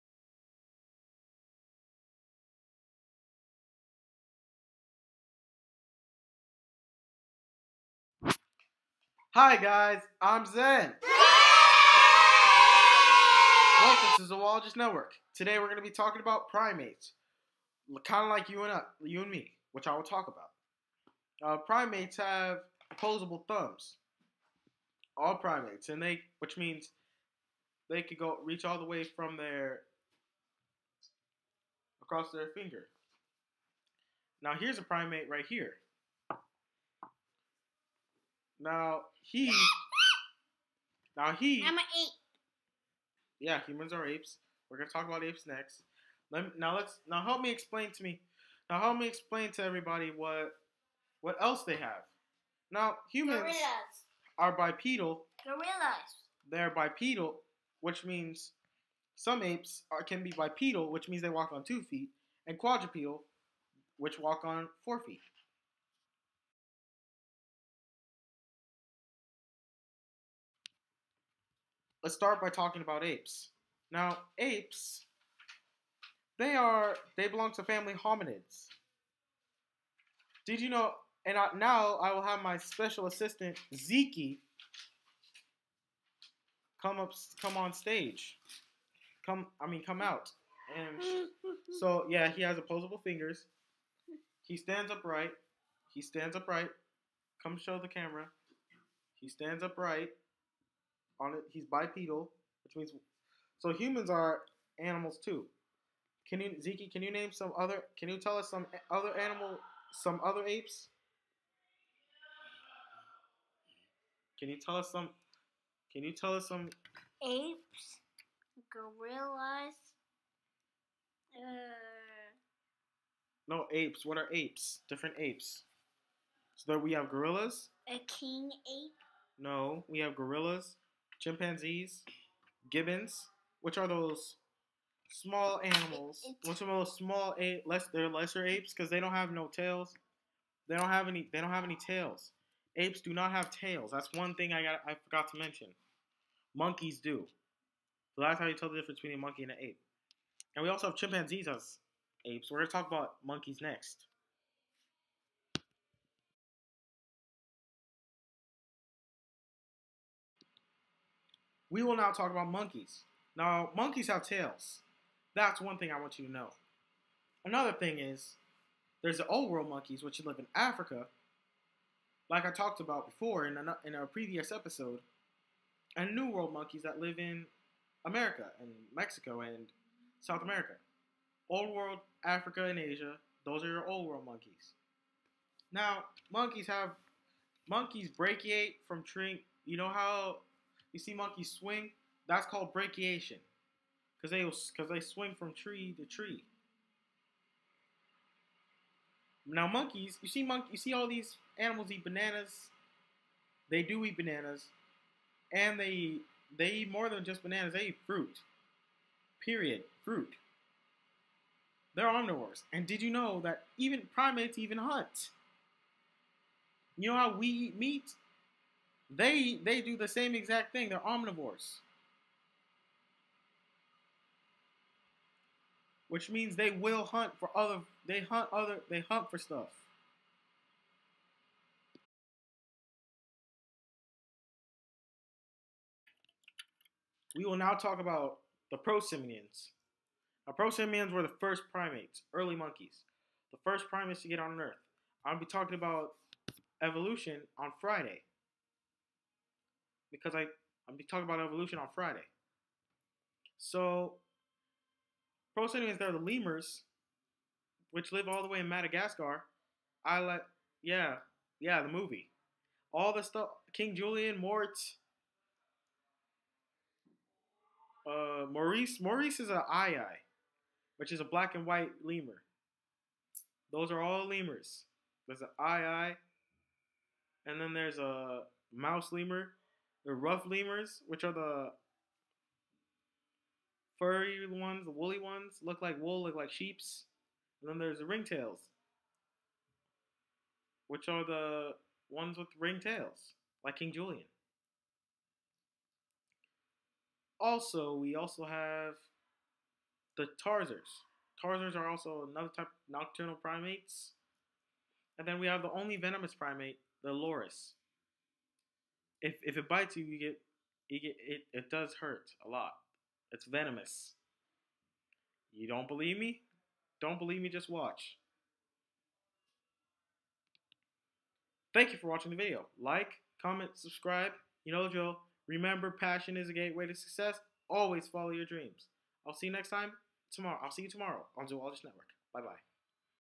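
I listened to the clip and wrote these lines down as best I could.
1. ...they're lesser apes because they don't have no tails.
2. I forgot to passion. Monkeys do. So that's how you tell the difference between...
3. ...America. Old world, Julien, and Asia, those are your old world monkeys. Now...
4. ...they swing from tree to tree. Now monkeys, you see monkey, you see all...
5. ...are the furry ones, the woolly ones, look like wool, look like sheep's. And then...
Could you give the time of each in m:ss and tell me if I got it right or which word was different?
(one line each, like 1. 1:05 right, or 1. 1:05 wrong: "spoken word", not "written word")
1. 2:17 right
2. 2:24 wrong: "mention", not "passion"
3. 3:00 wrong: "Africa", not "Julien"
4. 3:14 right
5. 4:41 right.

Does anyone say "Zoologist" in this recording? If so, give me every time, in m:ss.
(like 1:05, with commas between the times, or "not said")
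0:14, 5:31.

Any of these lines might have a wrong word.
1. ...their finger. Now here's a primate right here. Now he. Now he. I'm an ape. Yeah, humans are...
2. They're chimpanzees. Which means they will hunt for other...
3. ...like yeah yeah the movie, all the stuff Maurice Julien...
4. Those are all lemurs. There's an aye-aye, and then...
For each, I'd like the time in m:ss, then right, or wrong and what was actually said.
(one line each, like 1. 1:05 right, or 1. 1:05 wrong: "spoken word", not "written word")
1. 0:32 right
2. 3:40 wrong: "omnivores", not "chimpanzees"
3. 4:20 wrong: "King", not "Maurice"
4. 4:33 right.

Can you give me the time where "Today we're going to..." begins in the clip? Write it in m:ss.
0:15.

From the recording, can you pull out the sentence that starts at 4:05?
I'll be talking about evolution on Friday because I I'm talking about evolution on Friday.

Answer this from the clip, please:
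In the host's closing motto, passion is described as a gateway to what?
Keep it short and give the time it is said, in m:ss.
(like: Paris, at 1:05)
Success, at 5:26.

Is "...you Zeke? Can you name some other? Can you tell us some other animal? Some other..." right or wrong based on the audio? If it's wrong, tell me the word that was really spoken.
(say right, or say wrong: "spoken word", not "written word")
right.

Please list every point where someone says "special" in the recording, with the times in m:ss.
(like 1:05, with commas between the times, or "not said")
1:22.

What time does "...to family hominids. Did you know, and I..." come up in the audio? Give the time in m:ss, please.
1:17.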